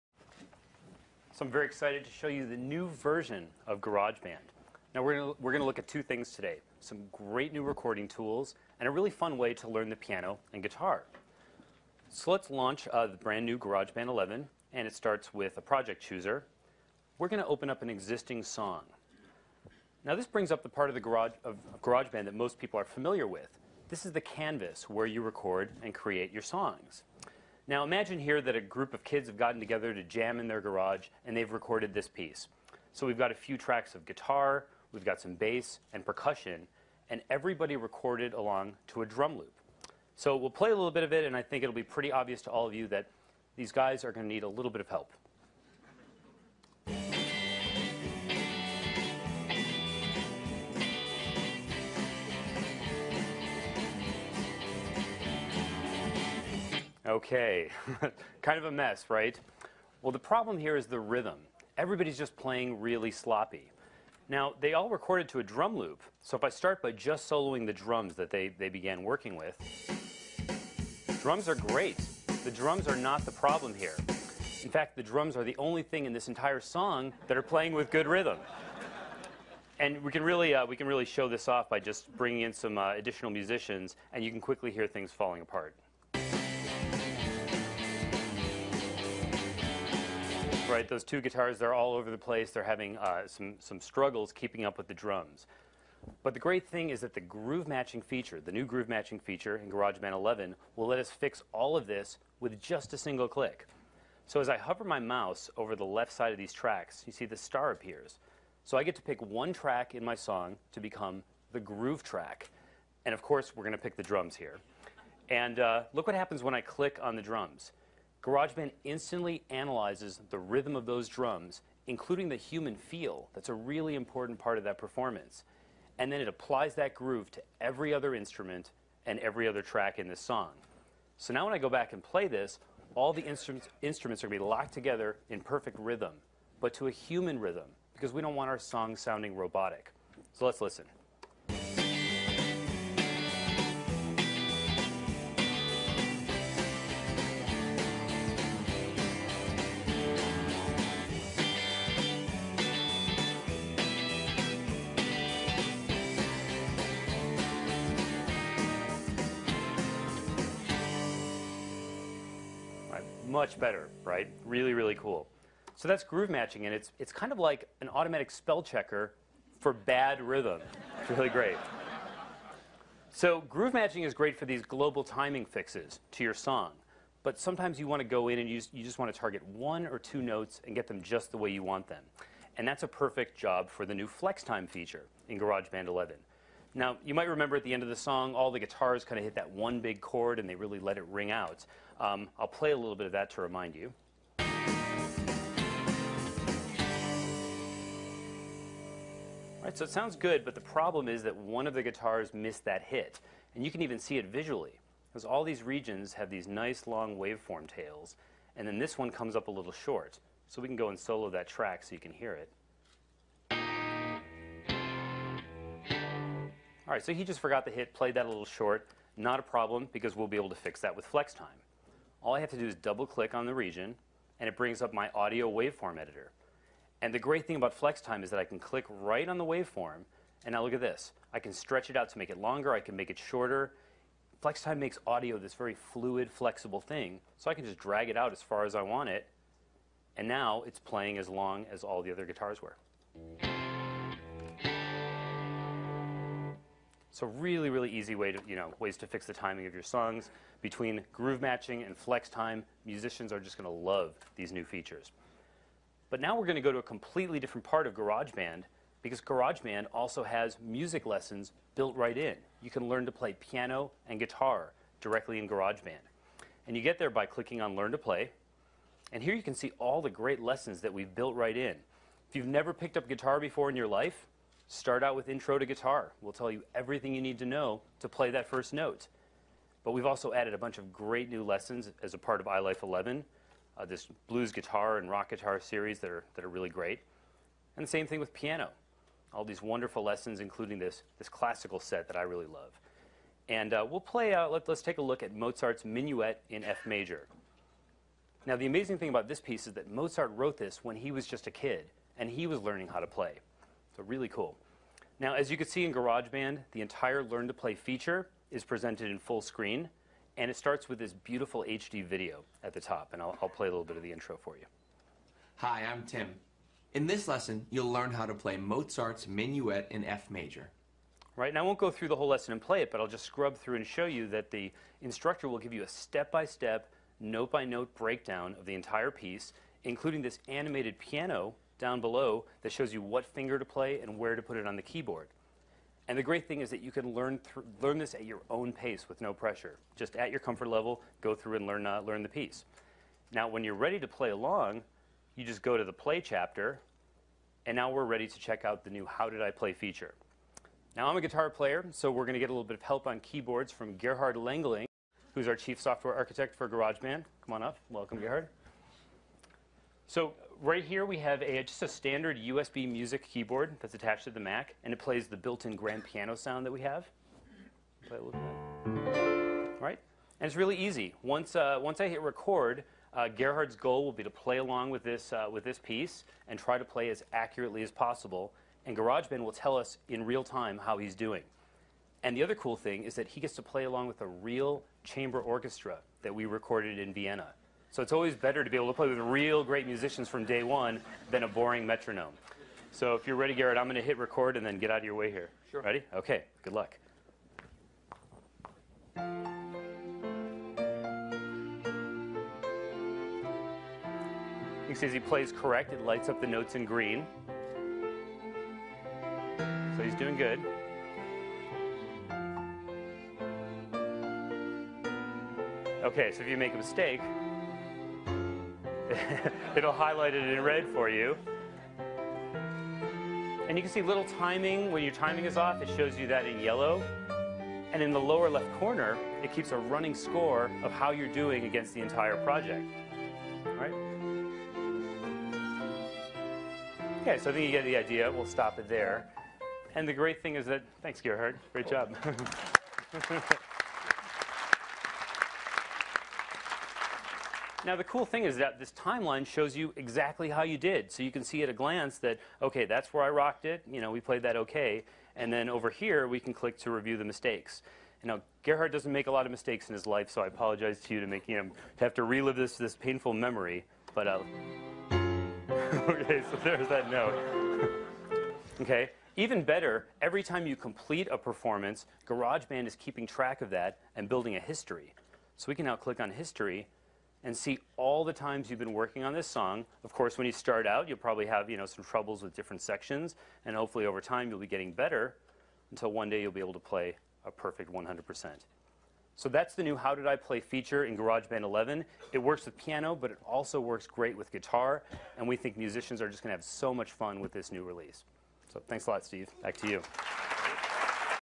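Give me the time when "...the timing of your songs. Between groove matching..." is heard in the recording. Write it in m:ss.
4:09.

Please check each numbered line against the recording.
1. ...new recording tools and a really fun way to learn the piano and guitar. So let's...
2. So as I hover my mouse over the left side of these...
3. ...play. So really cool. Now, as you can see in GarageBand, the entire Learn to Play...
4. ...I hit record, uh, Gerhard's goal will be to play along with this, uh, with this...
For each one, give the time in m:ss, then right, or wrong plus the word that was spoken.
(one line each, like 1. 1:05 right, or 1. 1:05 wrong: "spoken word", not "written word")
1. 0:07 right
2. 1:44 right
3. 5:03 right
4. 6:12 right.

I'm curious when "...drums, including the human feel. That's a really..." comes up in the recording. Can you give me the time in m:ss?
2:01.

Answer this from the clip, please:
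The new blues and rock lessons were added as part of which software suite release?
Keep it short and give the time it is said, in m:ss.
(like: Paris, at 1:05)
iLife 11, at 4:42.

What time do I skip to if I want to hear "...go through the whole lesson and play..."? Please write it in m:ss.
5:21.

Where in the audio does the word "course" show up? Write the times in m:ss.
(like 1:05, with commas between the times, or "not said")
1:53, 8:00.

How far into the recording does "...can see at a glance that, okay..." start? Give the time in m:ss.
7:31.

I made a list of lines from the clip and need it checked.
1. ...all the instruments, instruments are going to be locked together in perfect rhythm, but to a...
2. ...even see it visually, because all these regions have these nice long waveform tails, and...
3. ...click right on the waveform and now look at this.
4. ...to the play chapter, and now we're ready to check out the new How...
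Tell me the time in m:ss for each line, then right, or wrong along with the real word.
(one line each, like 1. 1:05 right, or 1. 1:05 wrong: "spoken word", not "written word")
1. 2:12 right
2. 3:23 right
3. 3:48 right
4. 5:45 right.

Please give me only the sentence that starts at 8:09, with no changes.
So that's the new How Did I Play feature in GarageBand 11.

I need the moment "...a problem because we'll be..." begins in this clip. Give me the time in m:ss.
3:39.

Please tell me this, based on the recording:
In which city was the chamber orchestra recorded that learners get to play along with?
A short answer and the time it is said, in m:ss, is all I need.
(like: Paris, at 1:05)
Vienna, at 6:27.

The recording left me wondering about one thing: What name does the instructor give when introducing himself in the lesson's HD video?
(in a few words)
Tim.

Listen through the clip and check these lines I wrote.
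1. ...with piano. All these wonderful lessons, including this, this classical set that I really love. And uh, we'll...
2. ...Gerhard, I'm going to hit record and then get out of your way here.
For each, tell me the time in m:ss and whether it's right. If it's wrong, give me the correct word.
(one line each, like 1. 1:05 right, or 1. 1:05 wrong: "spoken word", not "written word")
1. 4:48 right
2. 6:33 right.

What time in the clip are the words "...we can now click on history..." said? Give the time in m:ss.
7:55.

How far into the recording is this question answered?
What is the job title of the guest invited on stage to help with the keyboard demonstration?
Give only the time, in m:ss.
5:55.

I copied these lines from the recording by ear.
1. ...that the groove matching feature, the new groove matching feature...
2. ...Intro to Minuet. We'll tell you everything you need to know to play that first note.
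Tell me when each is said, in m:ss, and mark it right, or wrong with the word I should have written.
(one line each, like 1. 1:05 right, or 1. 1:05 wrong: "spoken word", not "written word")
1. 1:37 right
2. 4:35 wrong: "Guitar", not "Minuet".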